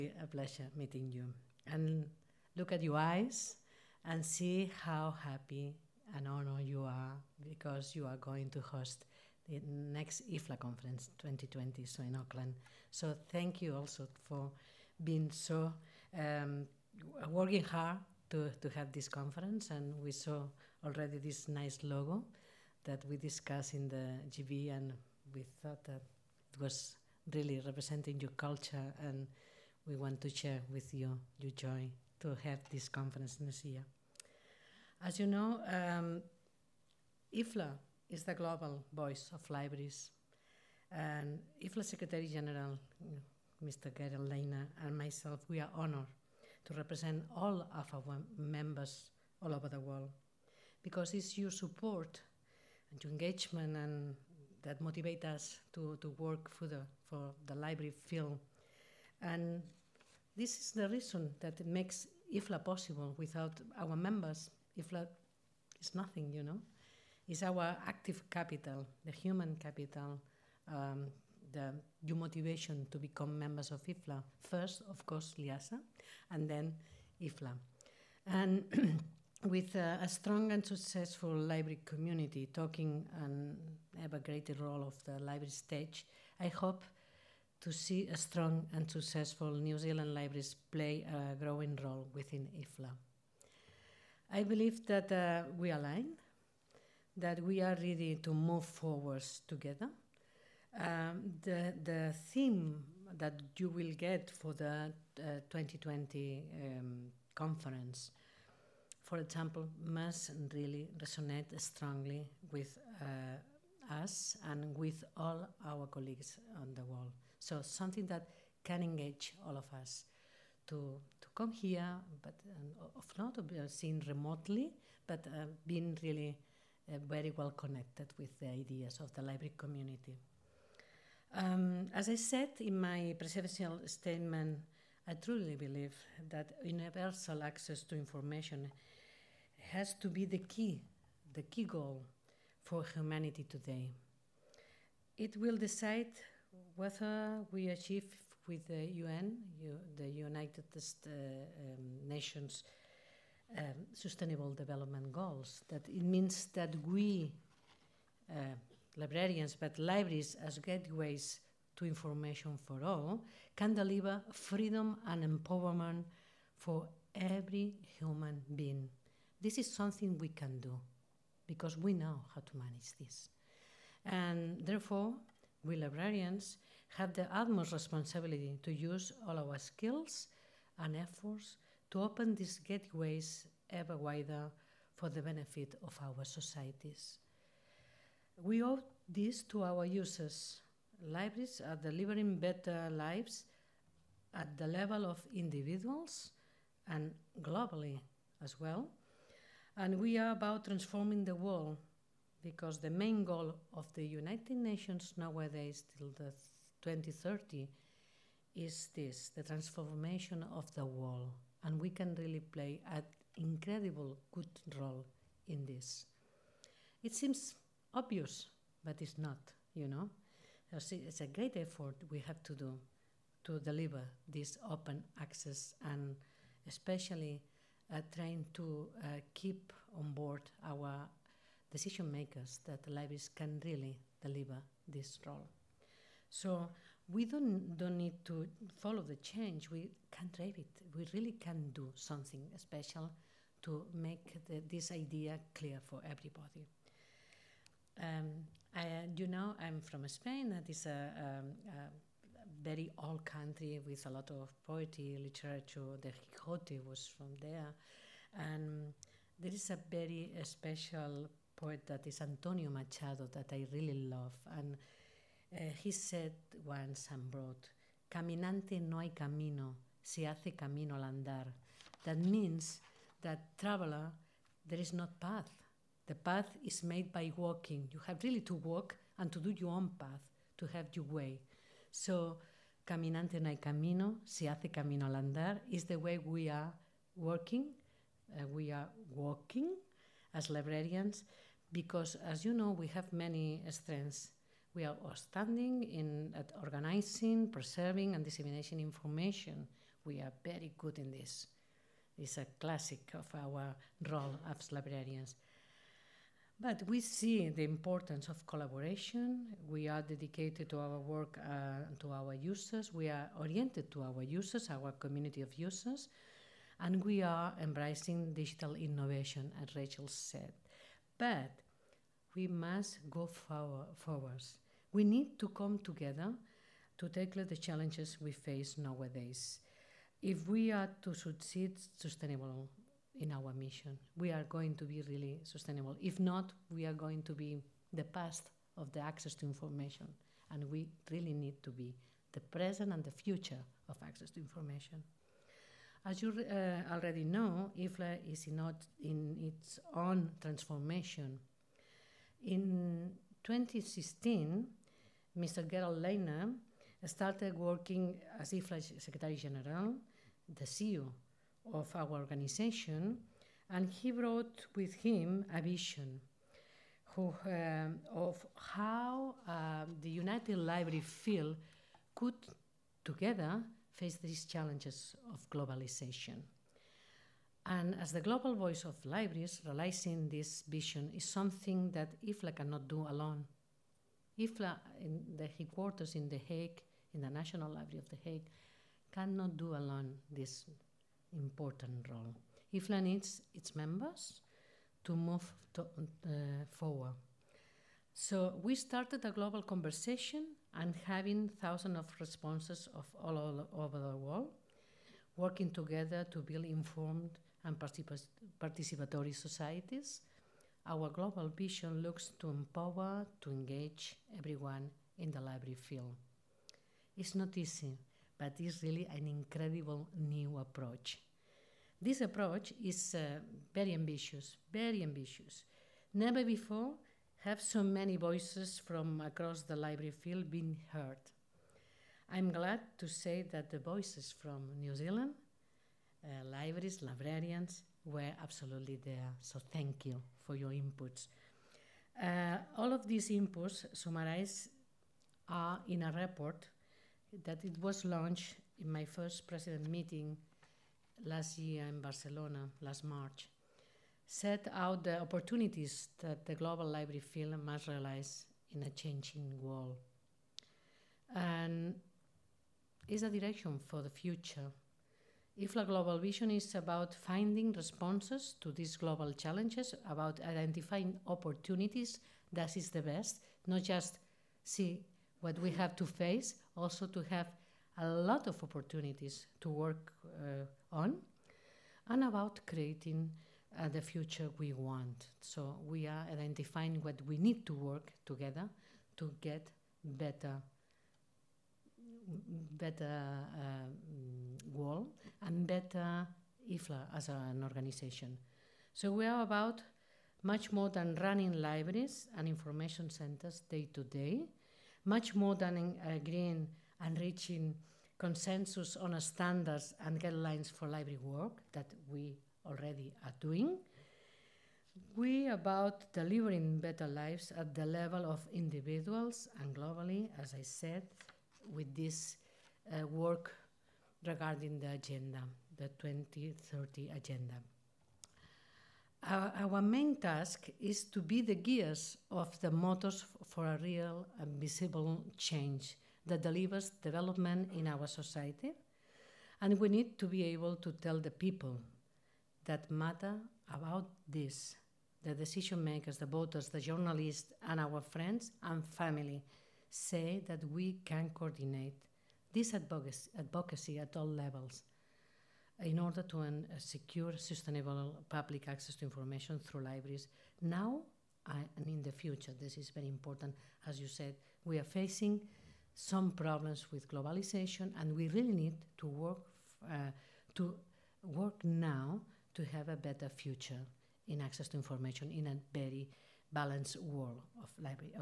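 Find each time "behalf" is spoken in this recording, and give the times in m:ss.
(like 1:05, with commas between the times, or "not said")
not said.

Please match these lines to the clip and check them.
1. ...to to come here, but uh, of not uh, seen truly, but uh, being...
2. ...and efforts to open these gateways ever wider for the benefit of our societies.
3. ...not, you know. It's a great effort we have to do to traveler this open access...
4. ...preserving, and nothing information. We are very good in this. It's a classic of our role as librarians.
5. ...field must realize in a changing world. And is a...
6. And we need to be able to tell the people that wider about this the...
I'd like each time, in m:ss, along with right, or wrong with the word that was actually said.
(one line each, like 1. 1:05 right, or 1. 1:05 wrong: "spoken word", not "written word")
1. 2:00 wrong: "remotely", not "truly"
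2. 3:00 right
3. 3:39 wrong: "deliver", not "traveler"
4. 4:57 wrong: "disseminating", not "nothing"
5. 7:37 right
6. 8:59 wrong: "matter", not "wider".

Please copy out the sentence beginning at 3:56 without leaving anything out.
So we don't, don't need to follow the change, we can drive it.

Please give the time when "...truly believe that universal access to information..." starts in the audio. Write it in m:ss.
2:15.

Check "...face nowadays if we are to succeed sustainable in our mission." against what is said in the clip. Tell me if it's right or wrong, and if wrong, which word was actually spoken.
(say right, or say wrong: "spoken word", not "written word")
right.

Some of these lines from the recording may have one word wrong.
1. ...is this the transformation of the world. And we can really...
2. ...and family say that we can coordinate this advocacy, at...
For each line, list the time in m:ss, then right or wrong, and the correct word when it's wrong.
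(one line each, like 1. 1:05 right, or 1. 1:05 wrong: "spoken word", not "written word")
1. 3:28 right
2. 9:08 right.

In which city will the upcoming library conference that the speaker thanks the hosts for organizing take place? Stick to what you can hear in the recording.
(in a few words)
Auckland.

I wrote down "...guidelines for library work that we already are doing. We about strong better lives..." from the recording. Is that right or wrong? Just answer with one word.
wrong.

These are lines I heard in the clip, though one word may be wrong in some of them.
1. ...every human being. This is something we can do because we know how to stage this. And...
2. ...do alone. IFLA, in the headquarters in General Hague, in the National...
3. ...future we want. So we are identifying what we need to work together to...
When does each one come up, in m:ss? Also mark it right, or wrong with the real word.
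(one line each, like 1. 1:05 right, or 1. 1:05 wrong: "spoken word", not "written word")
1. 2:47 wrong: "manage", not "stage"
2. 6:22 wrong: "The", not "General"
3. 8:04 right.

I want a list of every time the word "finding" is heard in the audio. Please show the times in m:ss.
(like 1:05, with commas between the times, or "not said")
7:47.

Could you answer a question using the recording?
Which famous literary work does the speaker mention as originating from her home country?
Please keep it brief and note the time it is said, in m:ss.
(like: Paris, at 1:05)
The Quijote, at 4:16.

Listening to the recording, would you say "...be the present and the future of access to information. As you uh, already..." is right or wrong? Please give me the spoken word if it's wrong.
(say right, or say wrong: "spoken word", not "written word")
right.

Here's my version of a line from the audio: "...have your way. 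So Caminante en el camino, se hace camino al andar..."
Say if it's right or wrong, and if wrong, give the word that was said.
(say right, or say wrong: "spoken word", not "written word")
right.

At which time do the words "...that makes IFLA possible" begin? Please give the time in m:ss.
1:01.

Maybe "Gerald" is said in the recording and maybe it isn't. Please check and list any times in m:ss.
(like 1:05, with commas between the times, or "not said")
0:43, 5:55.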